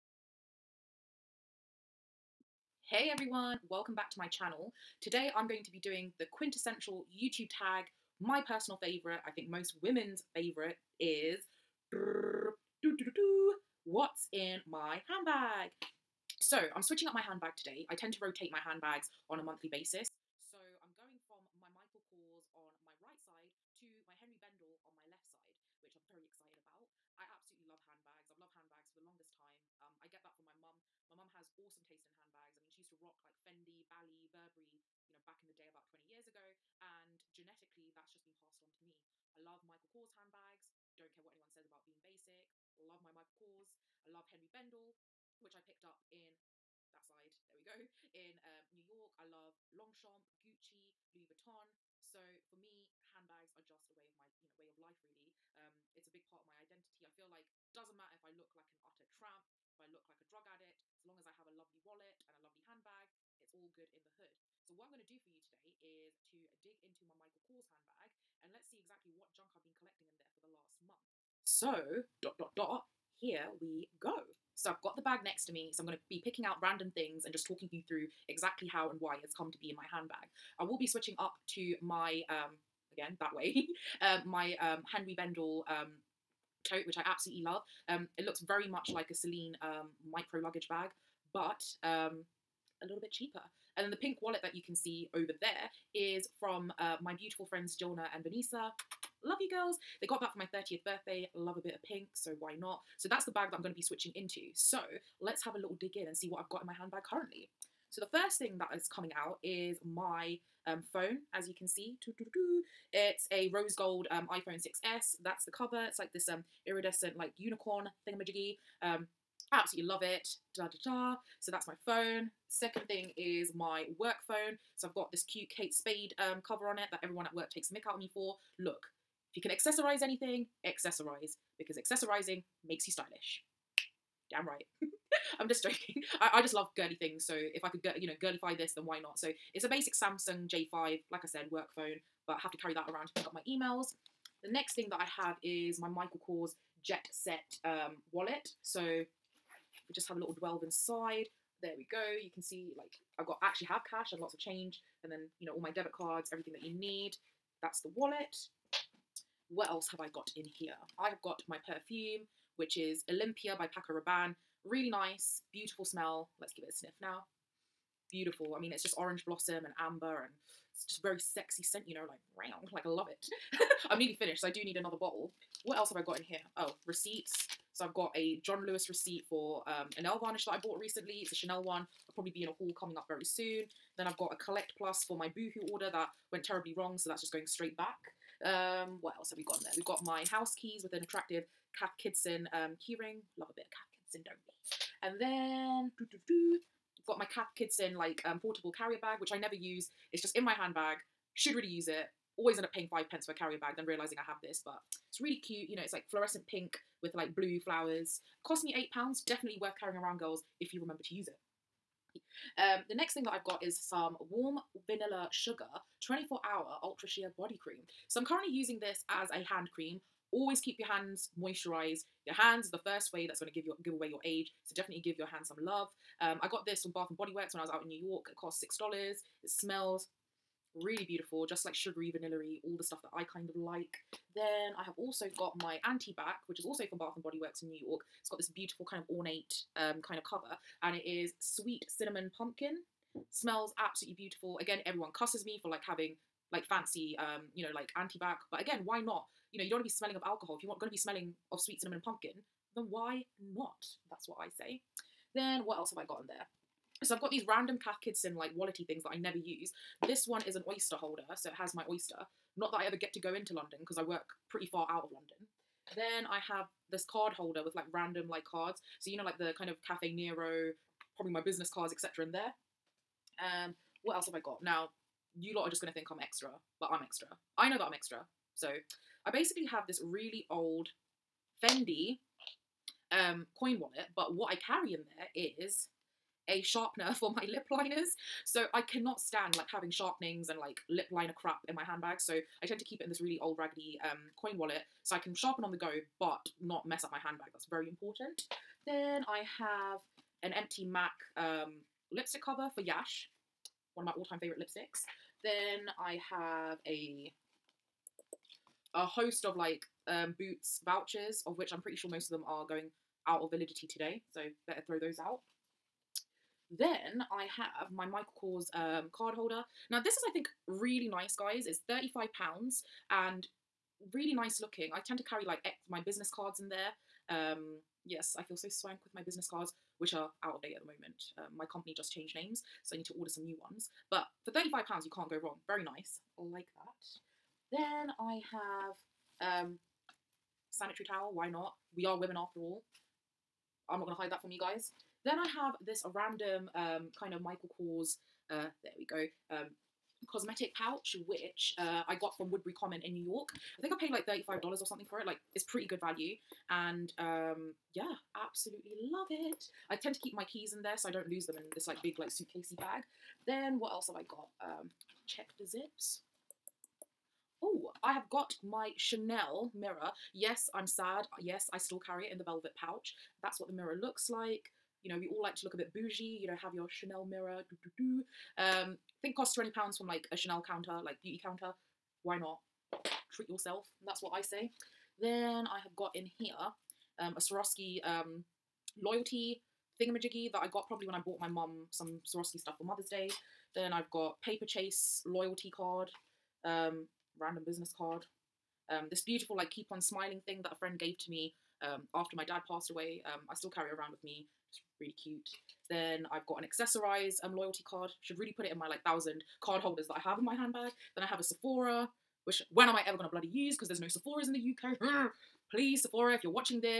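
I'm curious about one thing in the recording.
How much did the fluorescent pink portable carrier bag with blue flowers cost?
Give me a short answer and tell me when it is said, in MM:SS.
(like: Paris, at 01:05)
8 pounds, at 03:28.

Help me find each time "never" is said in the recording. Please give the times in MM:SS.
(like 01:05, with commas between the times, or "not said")
03:19, 04:19.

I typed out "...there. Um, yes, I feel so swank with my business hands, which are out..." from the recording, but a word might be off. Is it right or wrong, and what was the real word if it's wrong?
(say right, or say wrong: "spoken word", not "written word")
wrong: "cards", not "hands".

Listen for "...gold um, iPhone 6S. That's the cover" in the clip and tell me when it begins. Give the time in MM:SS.
01:53.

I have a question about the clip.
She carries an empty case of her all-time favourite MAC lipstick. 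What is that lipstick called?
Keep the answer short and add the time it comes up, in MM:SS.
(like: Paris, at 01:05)
Yash, at 05:02.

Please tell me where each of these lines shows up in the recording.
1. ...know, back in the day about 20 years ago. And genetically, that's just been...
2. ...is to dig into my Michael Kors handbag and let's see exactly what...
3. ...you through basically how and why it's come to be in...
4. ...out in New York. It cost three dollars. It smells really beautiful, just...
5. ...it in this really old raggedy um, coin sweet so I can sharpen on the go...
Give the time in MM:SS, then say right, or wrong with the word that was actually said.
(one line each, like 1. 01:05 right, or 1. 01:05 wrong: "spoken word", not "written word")
1. 00:35 right
2. 01:05 right
3. 01:17 wrong: "exactly", not "basically"
4. 03:47 wrong: "six", not "three"
5. 04:53 wrong: "wallet", not "sweet".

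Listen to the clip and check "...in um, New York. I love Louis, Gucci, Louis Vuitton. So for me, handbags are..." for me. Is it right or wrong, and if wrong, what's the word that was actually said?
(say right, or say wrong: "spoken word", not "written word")
wrong: "Longchamp", not "Louis".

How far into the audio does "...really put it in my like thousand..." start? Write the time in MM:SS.
06:48.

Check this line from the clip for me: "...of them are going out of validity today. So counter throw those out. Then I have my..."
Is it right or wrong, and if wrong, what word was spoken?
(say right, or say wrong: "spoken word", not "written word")
wrong: "better", not "counter".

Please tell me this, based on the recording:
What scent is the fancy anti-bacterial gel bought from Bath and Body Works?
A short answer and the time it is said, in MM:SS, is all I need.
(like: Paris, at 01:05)
sweet cinnamon pumpkin, at 04:01.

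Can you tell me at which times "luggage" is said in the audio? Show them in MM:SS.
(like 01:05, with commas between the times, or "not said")
01:30.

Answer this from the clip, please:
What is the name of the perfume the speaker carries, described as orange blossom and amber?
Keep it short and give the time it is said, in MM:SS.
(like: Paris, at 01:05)
Olympia, at 02:43.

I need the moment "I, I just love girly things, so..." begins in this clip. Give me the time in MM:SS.
02:16.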